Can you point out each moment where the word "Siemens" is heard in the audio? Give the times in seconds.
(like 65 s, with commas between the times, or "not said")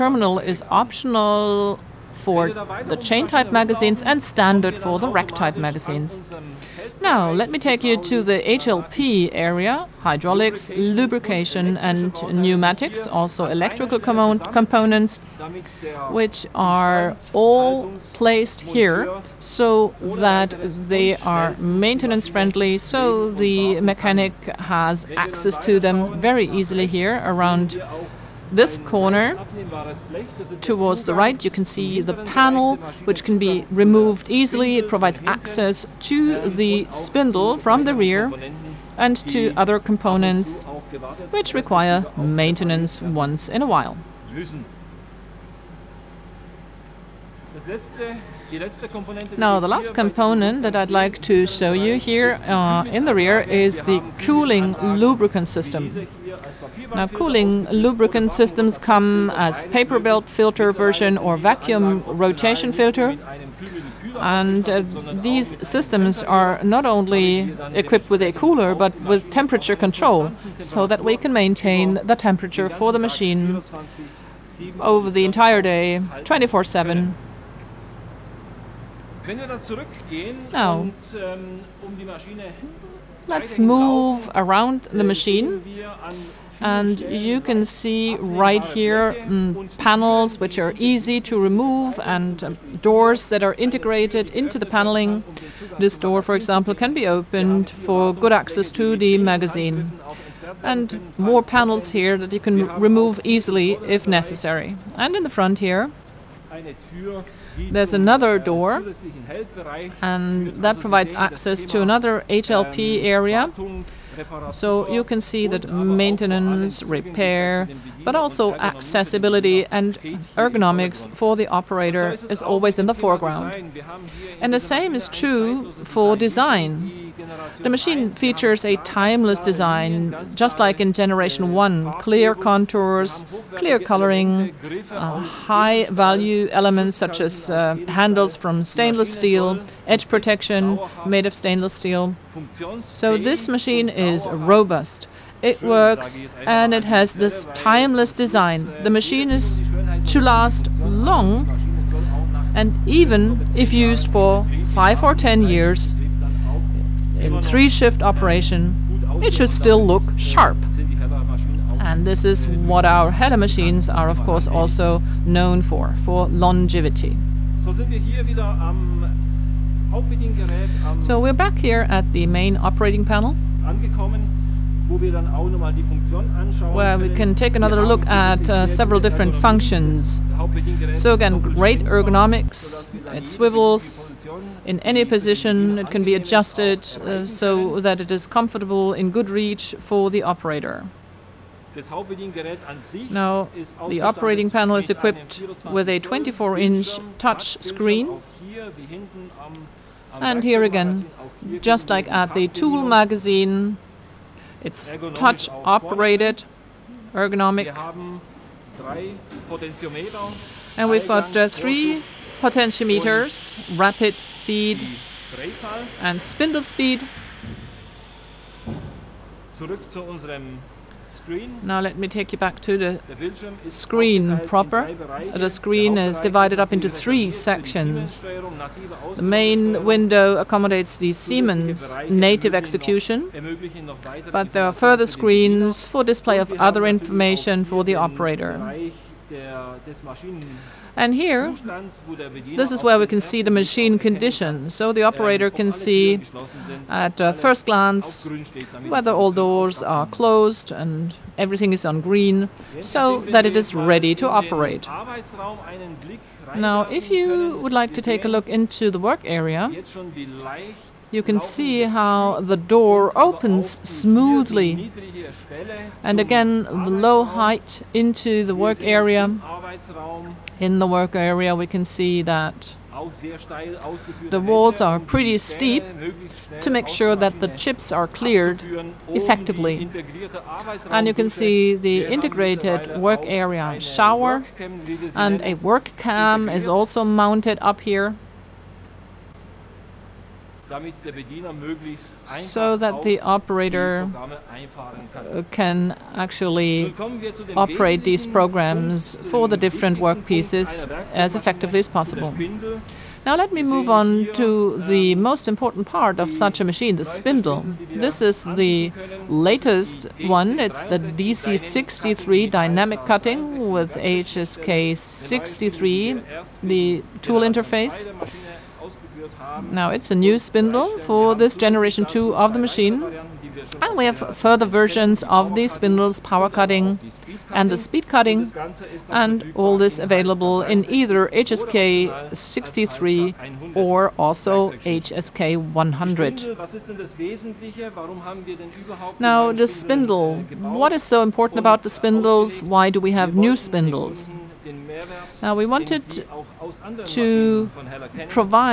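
231 s.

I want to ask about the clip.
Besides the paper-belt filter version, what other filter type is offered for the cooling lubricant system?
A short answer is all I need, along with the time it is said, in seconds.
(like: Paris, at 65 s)
Vacuum rotation filter, at 61 s.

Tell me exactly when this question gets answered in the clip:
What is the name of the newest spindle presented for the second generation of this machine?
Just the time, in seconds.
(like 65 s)
310 s.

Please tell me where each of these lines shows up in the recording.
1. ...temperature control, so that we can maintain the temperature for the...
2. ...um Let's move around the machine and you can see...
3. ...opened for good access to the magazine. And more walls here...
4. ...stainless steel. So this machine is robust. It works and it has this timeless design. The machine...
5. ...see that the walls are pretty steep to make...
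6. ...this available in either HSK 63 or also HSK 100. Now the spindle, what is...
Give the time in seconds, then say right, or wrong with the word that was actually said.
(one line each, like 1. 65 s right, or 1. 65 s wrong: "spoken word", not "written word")
1. 69 s right
2. 81 s right
3. 97 s wrong: "panels", not "walls"
4. 141 s right
5. 271 s right
6. 329 s right.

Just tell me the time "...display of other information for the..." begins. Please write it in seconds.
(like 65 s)
236 s.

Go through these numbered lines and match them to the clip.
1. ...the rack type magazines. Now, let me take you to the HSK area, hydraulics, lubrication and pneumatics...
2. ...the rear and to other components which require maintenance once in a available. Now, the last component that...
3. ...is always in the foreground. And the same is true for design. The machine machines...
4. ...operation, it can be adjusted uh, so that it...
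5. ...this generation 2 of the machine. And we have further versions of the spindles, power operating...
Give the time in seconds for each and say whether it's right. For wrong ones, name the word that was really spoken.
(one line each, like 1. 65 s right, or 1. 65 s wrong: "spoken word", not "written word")
1. 4 s wrong: "HLP", not "HSK"
2. 37 s wrong: "while", not "available"
3. 122 s wrong: "features", not "machines"
4. 185 s wrong: "position", not "operation"
5. 321 s wrong: "cutting", not "operating".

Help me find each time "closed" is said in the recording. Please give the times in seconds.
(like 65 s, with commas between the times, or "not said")
250 s.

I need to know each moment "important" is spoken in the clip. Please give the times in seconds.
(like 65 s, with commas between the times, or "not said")
305 s, 341 s.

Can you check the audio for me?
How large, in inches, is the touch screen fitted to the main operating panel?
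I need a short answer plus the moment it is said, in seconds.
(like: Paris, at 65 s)
24, at 196 s.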